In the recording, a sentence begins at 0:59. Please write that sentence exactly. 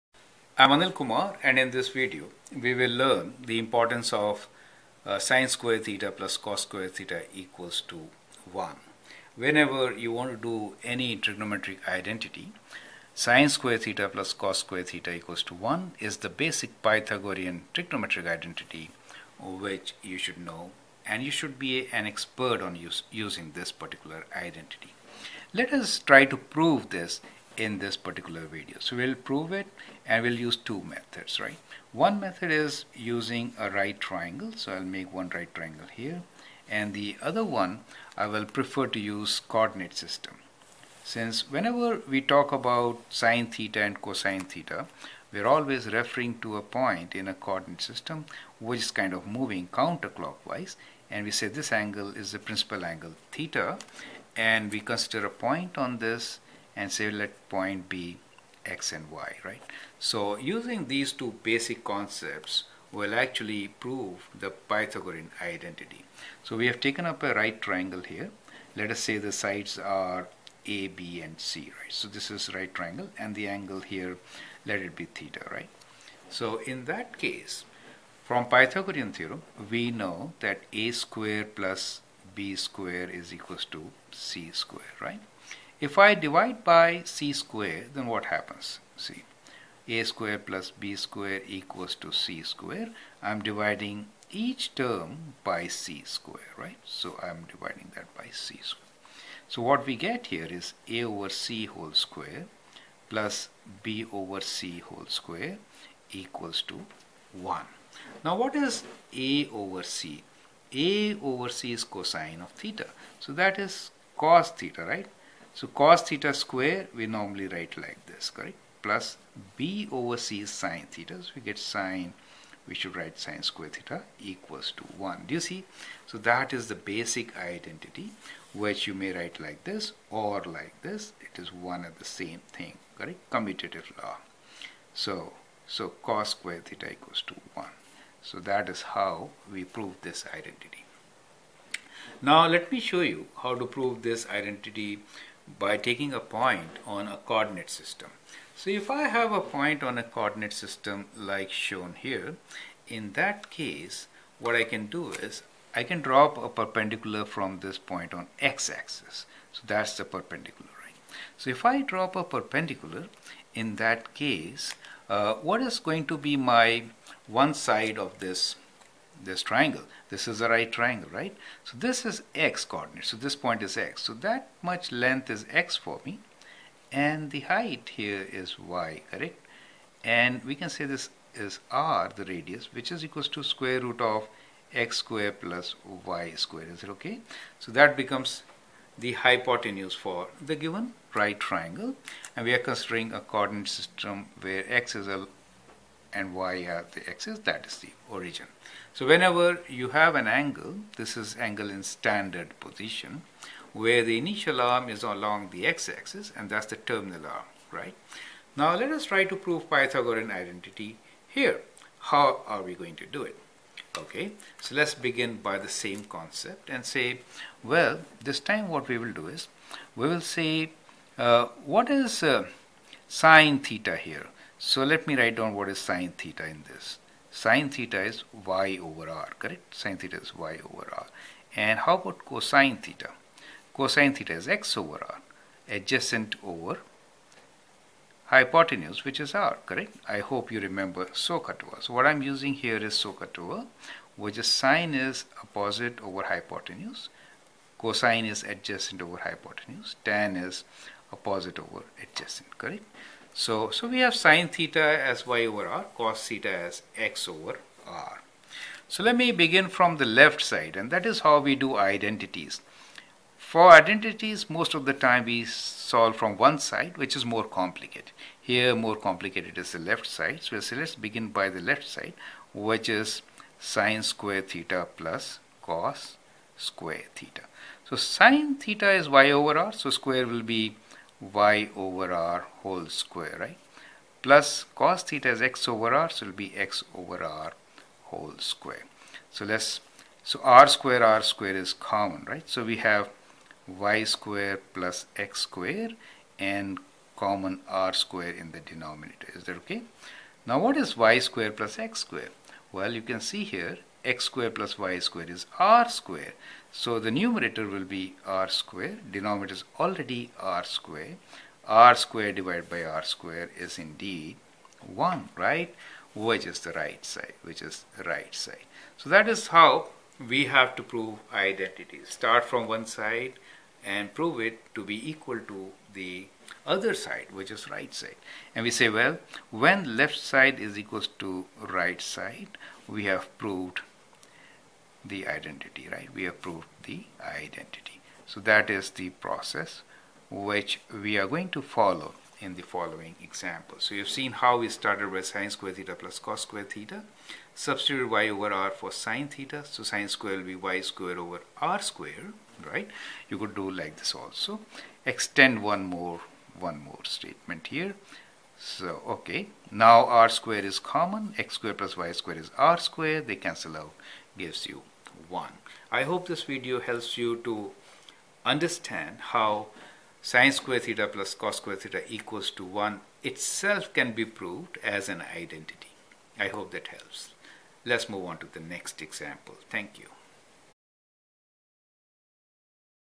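So using these two basic concepts will actually prove the Pythagorean identity.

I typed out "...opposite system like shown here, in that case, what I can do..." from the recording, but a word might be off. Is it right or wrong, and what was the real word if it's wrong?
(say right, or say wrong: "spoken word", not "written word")
wrong: "coordinate", not "opposite".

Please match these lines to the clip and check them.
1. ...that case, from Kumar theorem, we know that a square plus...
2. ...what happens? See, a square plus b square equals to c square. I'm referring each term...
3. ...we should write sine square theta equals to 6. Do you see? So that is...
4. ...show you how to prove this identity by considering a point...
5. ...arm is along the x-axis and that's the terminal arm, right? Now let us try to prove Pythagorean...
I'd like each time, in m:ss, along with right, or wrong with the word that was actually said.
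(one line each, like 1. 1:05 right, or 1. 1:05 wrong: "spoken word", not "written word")
1. 1:16 wrong: "Pythagorean", not "Kumar"
2. 1:28 wrong: "dividing", not "referring"
3. 2:02 wrong: "1", not "6"
4. 2:22 wrong: "taking", not "considering"
5. 3:24 right.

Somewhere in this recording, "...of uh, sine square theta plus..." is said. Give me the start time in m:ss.
0:04.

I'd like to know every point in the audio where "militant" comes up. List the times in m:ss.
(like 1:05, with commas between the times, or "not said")
not said.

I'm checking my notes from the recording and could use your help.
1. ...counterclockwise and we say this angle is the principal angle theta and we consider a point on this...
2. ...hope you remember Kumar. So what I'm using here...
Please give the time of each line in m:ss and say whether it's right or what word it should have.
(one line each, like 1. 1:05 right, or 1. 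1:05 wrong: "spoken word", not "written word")
1. 0:49 right
2. 4:00 wrong: "SOHCAHTOA", not "Kumar".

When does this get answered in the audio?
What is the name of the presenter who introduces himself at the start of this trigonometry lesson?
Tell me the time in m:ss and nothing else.
0:00.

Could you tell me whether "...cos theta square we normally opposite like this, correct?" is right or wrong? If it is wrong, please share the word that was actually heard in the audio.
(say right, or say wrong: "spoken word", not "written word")
wrong: "write", not "opposite".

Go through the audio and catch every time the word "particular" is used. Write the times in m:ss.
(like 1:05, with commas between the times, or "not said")
0:23, 0:27.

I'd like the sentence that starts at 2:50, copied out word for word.
This is a right triangle, right?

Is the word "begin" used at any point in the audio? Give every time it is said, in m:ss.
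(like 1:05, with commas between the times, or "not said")
3:34, 4:19, 4:30.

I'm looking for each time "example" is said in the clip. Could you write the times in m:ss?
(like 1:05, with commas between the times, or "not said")
5:43, 6:19.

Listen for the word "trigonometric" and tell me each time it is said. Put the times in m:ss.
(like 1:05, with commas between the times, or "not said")
0:11, 0:17.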